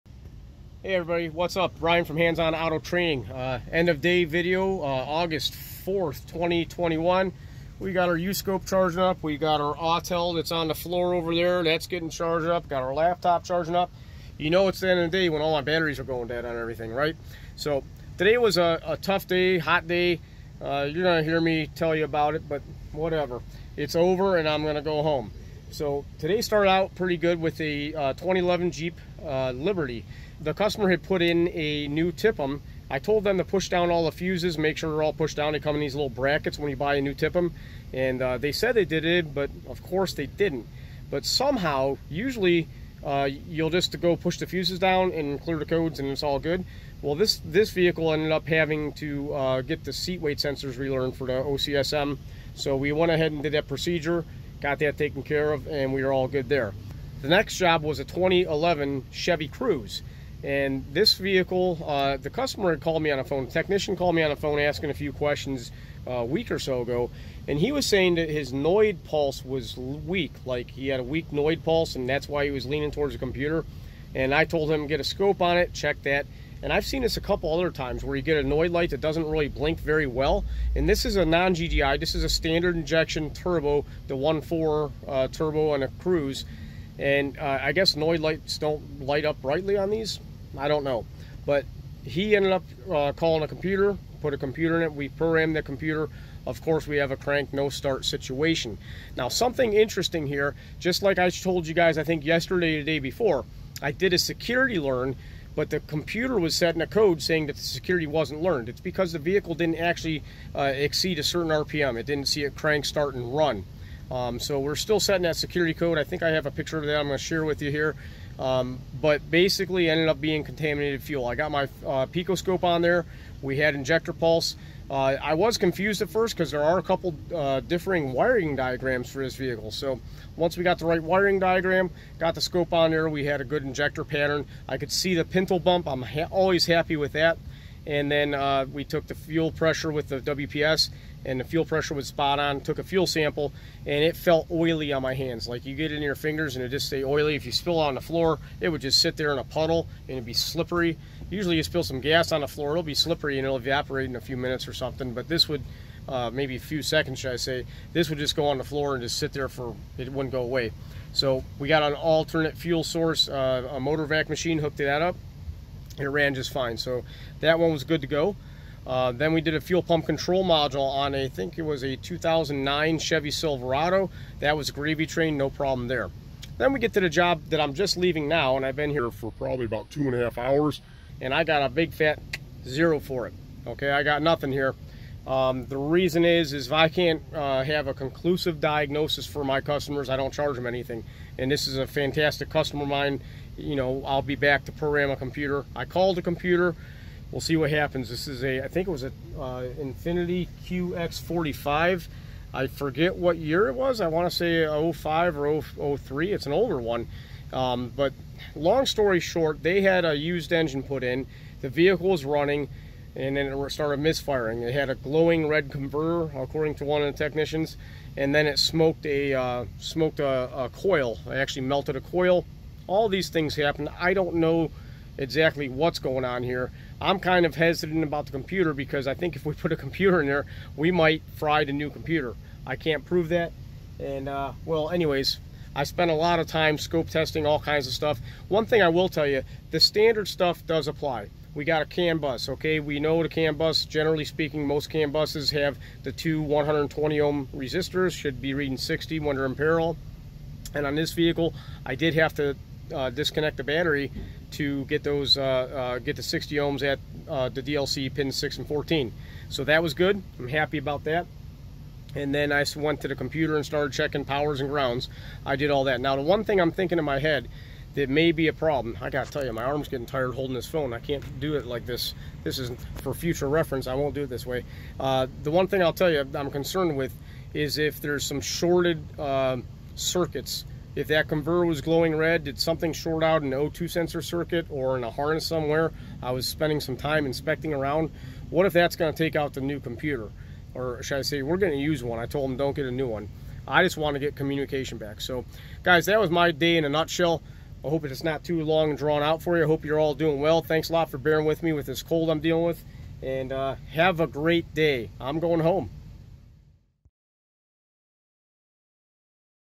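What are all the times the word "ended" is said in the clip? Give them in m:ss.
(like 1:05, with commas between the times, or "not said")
0:48, 1:32, 1:59.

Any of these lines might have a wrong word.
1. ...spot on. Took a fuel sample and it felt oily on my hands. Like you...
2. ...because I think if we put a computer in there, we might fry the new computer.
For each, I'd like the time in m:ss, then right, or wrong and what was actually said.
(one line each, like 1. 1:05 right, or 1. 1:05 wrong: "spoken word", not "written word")
1. 2:22 right
2. 3:48 right.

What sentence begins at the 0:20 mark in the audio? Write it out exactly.
Uh, you're going to hear me tell you about it, but whatever.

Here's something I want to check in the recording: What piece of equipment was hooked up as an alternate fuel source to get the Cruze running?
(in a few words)
motor vac machine.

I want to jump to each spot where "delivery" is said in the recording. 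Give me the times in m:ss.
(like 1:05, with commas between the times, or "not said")
not said.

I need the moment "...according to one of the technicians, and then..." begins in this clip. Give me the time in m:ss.
3:36.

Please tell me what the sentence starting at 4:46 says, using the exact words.
I was spending some time inspecting around.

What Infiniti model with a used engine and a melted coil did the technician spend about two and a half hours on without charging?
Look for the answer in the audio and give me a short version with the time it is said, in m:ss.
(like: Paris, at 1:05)
QX45, at 3:20.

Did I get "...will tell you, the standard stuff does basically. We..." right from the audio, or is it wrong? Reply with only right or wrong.
wrong.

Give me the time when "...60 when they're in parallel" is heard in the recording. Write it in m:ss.
4:08.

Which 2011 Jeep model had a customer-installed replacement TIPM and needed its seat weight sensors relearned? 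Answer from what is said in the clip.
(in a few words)
Liberty.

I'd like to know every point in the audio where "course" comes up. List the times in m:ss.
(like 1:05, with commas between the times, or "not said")
0:39, 1:36.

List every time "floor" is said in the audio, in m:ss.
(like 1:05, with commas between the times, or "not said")
0:10, 2:28, 2:32, 2:38.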